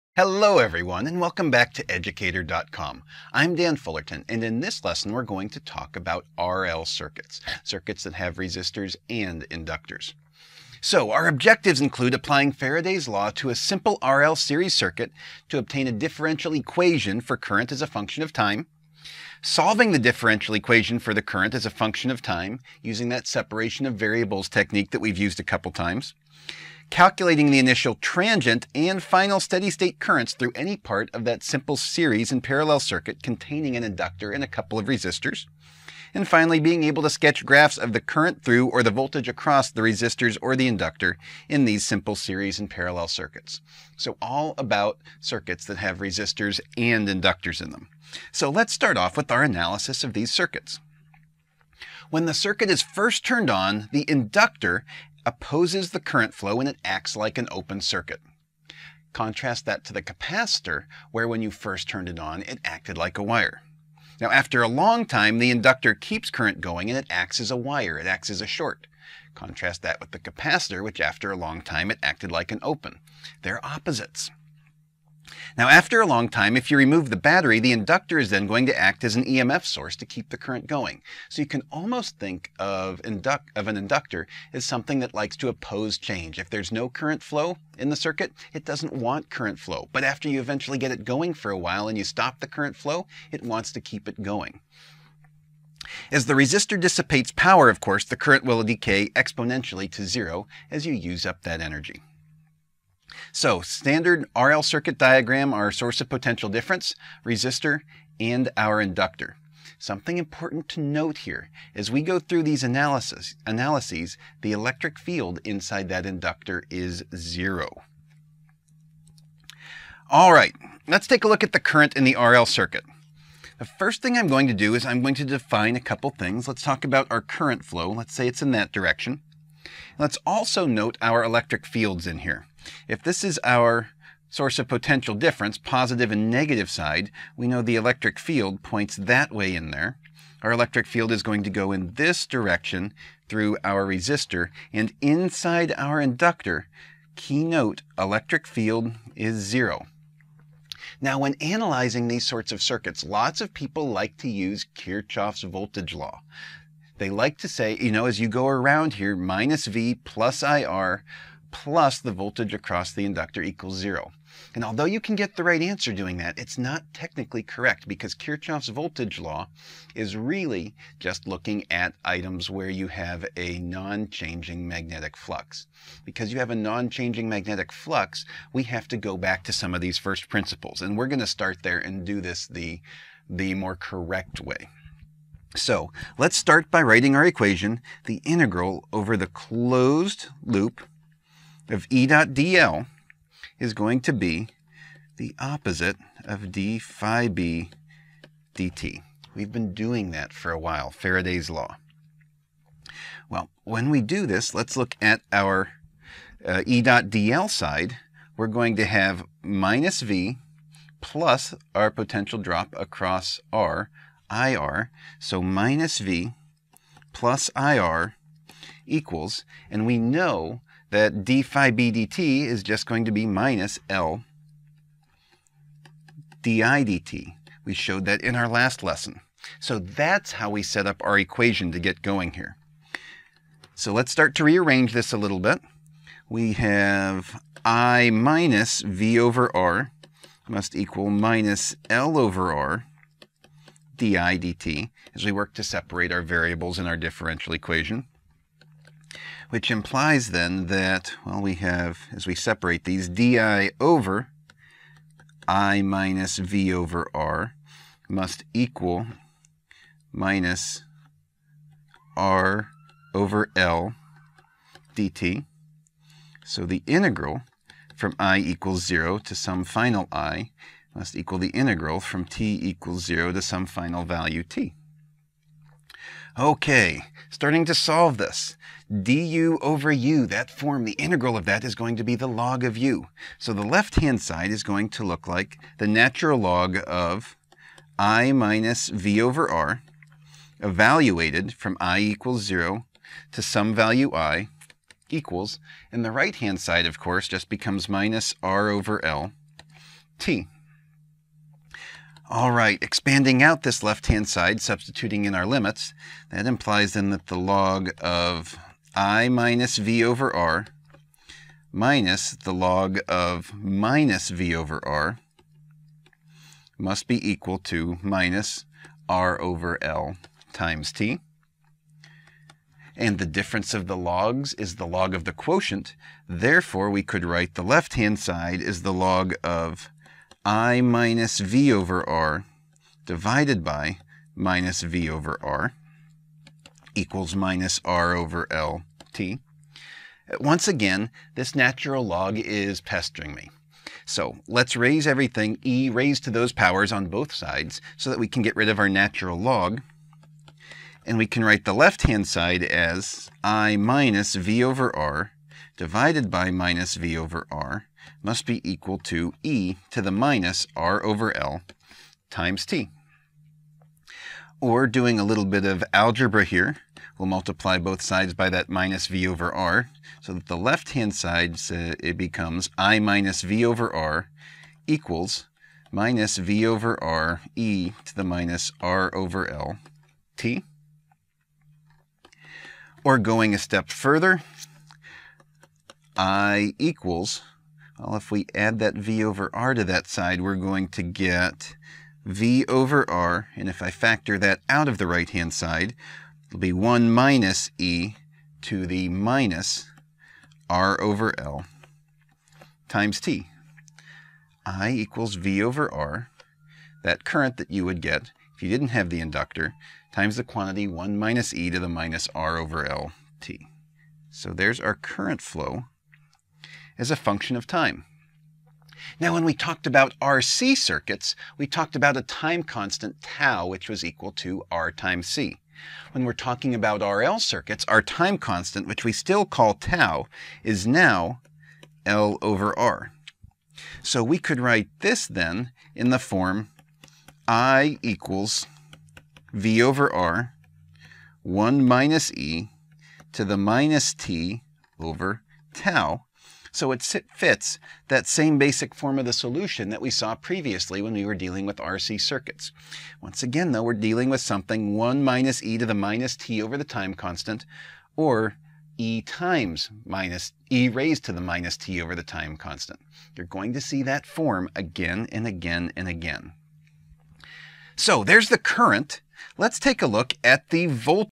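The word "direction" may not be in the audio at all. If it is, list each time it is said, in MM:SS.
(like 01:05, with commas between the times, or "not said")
02:08, 02:22.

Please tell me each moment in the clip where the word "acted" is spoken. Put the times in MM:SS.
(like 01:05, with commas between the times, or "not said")
01:02, 01:12.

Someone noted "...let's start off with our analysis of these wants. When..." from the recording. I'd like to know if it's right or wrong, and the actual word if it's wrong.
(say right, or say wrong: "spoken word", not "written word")
wrong: "circuits", not "wants".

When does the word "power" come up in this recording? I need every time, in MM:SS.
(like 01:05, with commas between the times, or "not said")
01:37, 05:46.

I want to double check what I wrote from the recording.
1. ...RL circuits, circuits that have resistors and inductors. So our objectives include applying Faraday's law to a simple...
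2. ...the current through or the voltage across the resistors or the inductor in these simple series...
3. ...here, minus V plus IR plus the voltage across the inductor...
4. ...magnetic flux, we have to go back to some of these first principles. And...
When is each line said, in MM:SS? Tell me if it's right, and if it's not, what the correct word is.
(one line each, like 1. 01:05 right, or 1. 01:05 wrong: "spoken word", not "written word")
1. 00:06 right
2. 00:37 right
3. 02:38 right
4. 02:57 right.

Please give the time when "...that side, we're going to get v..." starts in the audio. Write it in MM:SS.
06:29.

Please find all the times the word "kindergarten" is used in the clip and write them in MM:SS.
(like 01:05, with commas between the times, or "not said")
not said.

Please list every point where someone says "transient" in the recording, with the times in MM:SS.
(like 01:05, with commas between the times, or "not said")
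00:27.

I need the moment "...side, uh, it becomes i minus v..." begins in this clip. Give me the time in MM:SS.
06:11.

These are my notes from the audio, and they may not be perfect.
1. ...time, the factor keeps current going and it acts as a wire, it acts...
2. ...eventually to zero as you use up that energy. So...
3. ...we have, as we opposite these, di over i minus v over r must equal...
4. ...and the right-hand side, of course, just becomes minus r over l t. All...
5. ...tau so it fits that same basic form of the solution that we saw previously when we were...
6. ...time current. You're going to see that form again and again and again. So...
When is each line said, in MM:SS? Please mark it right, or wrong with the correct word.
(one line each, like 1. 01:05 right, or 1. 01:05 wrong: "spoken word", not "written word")
1. 01:05 wrong: "inductor", not "factor"
2. 01:39 wrong: "exponentially", not "eventually"
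3. 04:11 wrong: "separate", not "opposite"
4. 04:55 right
5. 07:25 right
6. 07:42 wrong: "constant", not "current".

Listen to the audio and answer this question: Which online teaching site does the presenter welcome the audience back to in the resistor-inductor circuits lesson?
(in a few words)
educator.com.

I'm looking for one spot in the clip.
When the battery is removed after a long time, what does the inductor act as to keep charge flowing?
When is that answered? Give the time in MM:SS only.
01:19.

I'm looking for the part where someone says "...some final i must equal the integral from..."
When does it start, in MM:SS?
04:29.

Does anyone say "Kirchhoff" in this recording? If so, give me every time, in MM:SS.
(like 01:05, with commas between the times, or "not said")
02:34, 02:48.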